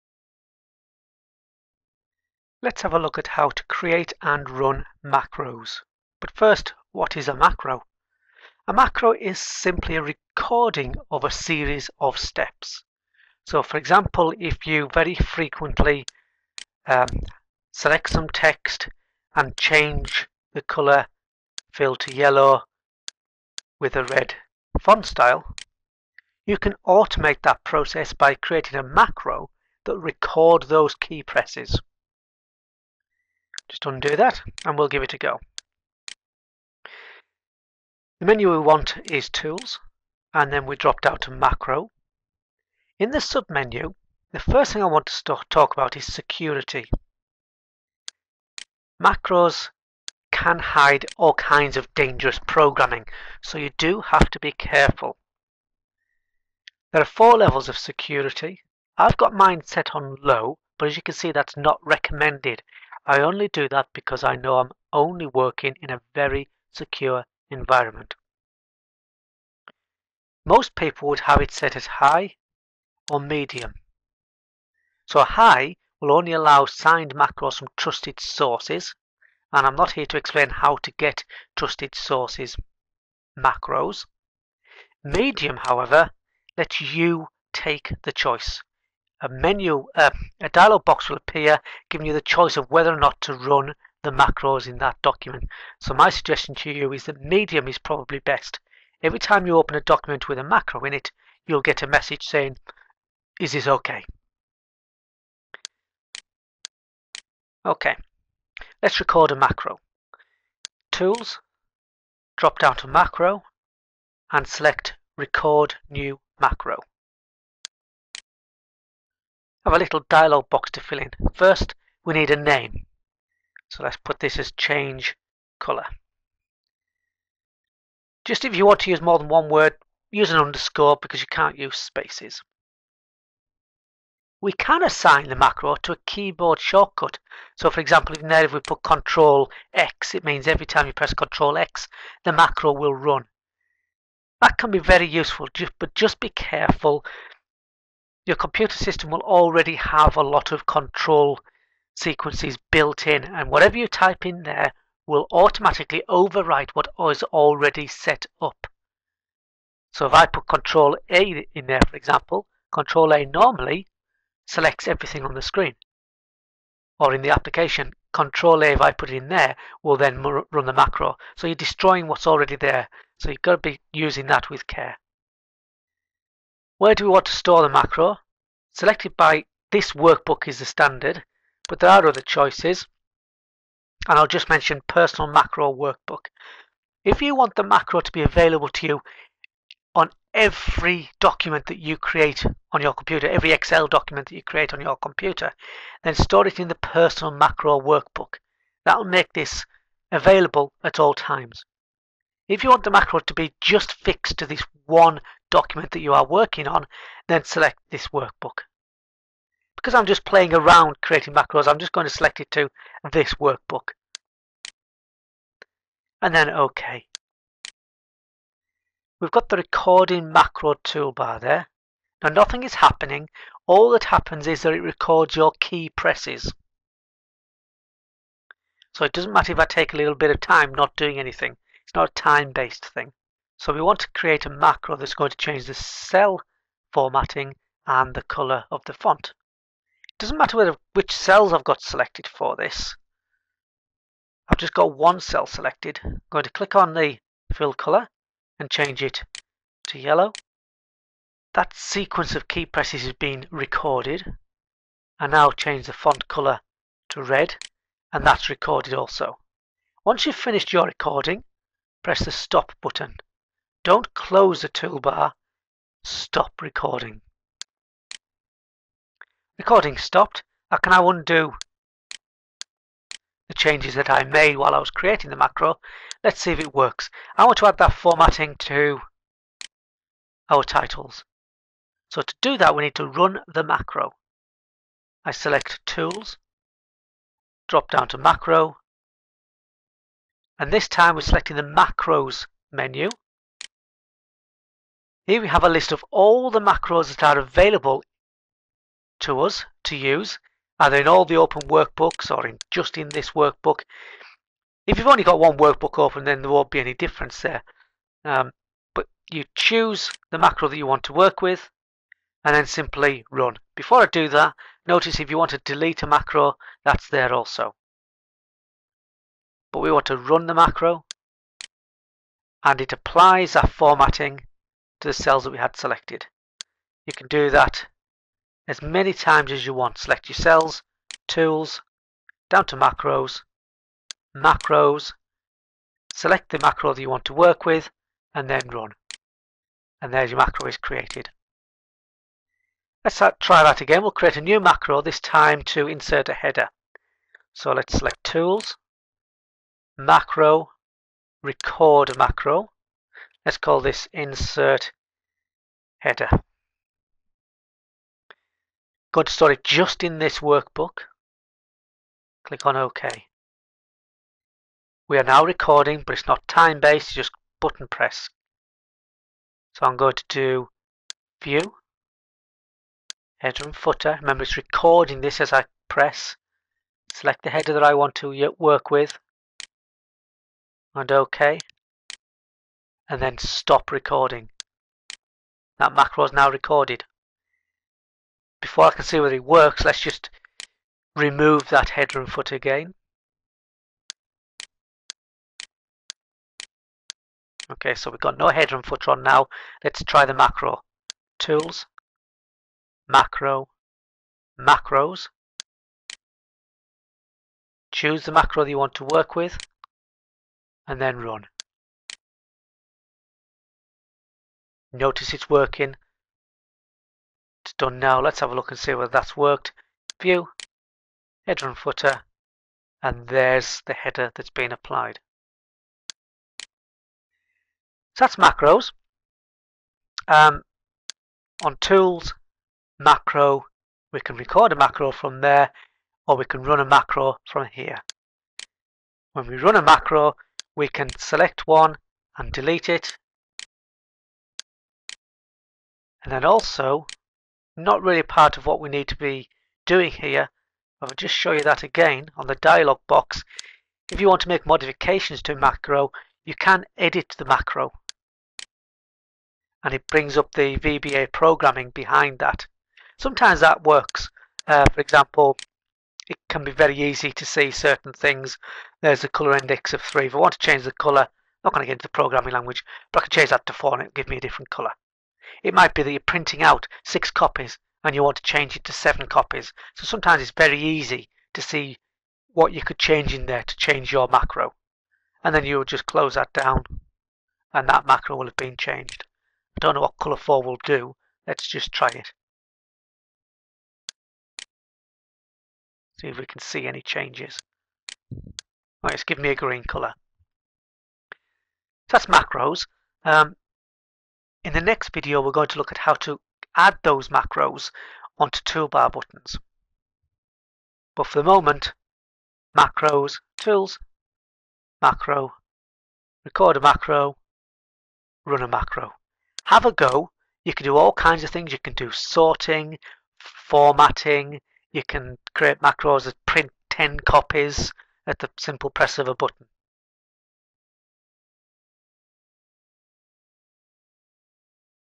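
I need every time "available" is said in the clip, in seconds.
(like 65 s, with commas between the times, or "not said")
188 s, 200 s, 297 s.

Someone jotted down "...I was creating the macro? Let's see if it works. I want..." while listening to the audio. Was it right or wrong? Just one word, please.
right.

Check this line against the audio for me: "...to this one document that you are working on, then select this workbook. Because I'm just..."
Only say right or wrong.
right.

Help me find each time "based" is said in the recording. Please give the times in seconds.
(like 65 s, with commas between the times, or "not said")
232 s, 366 s.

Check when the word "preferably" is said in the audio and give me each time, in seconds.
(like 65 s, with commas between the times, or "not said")
not said.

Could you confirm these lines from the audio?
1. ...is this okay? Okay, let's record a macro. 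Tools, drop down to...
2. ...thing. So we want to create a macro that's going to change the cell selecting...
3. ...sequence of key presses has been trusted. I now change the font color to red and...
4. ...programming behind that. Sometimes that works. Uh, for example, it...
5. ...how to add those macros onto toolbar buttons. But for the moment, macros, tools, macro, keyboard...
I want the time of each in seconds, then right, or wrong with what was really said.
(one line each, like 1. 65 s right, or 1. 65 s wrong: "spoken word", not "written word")
1. 103 s right
2. 232 s wrong: "formatting", not "selecting"
3. 251 s wrong: "recorded", not "trusted"
4. 461 s right
5. 505 s wrong: "record", not "keyboard".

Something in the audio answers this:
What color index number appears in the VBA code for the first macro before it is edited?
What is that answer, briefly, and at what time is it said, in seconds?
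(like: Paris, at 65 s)
3, at 470 s.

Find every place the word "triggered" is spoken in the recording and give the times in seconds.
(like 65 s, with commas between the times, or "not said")
not said.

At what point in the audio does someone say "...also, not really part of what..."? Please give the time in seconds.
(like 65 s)
446 s.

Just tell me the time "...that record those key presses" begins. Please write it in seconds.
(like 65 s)
29 s.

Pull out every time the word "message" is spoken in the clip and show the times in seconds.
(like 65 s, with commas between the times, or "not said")
101 s.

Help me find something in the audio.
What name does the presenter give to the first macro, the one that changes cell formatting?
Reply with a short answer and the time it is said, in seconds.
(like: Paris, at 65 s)
change color, at 124 s.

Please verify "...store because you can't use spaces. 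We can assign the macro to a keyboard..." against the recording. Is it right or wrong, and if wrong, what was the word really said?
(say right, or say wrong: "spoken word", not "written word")
wrong: "underscore", not "store".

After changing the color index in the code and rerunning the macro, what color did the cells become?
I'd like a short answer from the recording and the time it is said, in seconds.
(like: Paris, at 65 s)
green, at 499 s.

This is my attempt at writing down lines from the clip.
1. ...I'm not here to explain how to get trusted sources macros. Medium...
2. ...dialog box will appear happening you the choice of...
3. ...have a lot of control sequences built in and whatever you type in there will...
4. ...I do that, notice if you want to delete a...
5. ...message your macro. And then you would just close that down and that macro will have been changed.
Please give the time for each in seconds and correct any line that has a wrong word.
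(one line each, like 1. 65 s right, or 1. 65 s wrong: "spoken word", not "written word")
1. 79 s right
2. 90 s wrong: "giving", not "happening"
3. 149 s right
4. 314 s right
5. 483 s wrong: "change", not "message".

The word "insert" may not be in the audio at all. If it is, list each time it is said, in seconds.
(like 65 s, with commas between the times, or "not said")
345 s, 354 s.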